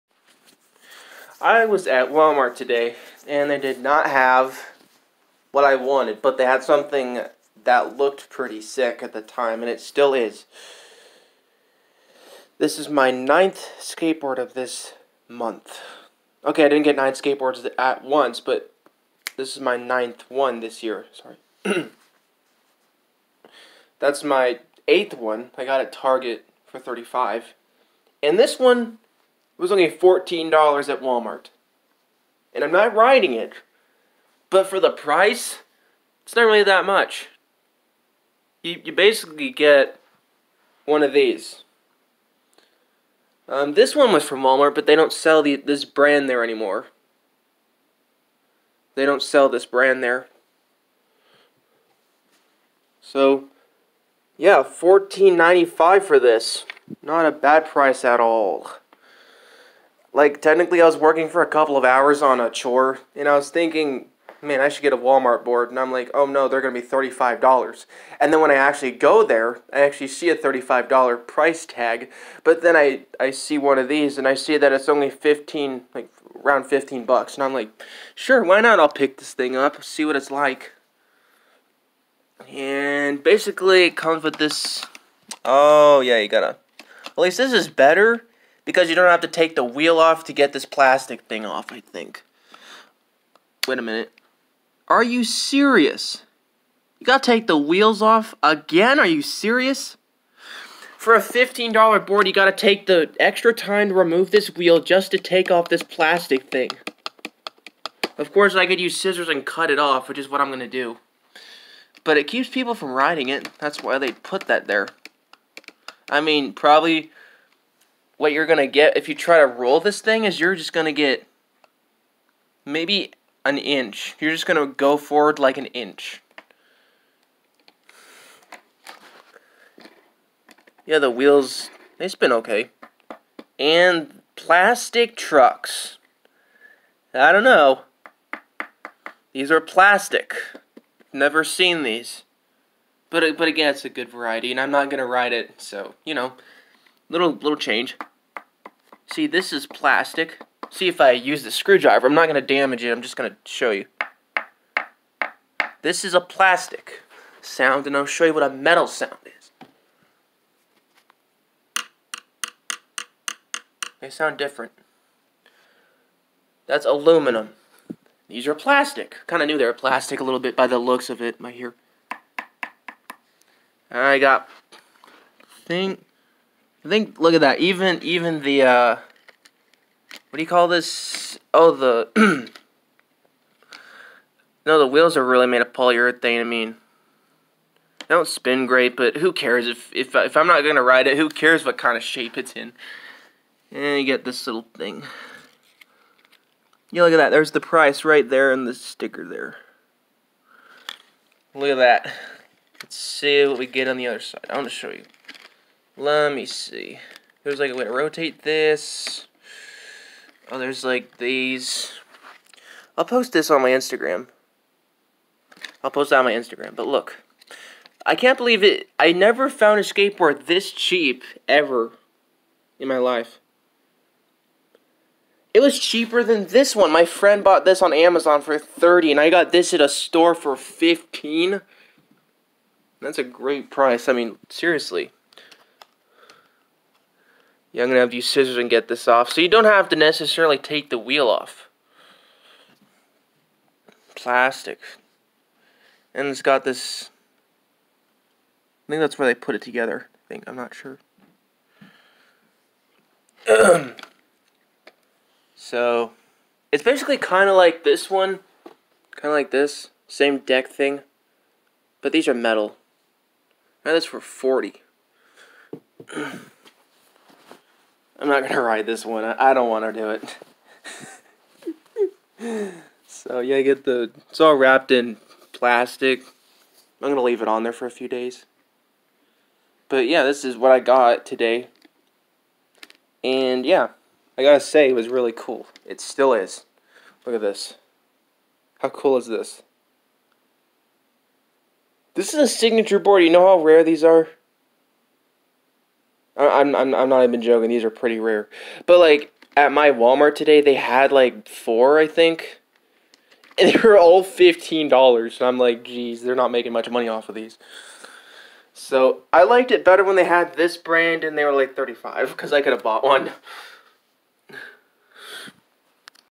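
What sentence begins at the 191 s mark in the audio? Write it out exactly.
Who cares what kind of shape it's in?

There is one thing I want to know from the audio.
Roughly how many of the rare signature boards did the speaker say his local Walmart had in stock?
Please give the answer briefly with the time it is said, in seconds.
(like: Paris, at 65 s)
4, at 301 s.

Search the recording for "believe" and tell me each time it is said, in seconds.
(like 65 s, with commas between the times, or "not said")
218 s.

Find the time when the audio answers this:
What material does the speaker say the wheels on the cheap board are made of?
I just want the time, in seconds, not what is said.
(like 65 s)
185 s.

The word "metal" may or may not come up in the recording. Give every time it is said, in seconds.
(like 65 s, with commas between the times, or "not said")
158 s, 262 s.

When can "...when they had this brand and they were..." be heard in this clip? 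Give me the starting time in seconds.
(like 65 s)
310 s.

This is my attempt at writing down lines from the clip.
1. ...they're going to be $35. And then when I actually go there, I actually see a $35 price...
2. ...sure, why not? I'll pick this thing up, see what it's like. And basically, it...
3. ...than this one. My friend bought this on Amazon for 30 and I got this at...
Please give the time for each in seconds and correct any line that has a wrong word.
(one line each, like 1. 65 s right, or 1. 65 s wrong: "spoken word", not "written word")
1. 66 s right
2. 78 s right
3. 226 s right.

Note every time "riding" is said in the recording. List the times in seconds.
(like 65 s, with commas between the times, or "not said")
32 s, 112 s.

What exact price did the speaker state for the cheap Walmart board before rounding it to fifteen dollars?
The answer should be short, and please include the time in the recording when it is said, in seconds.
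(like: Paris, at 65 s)
$14.95, at 54 s.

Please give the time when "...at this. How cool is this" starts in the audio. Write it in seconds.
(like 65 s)
287 s.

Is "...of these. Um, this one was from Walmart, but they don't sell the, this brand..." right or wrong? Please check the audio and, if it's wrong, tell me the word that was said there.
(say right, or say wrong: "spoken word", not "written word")
right.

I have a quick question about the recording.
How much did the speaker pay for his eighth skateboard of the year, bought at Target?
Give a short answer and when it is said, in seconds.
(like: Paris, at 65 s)
$35, at 25 s.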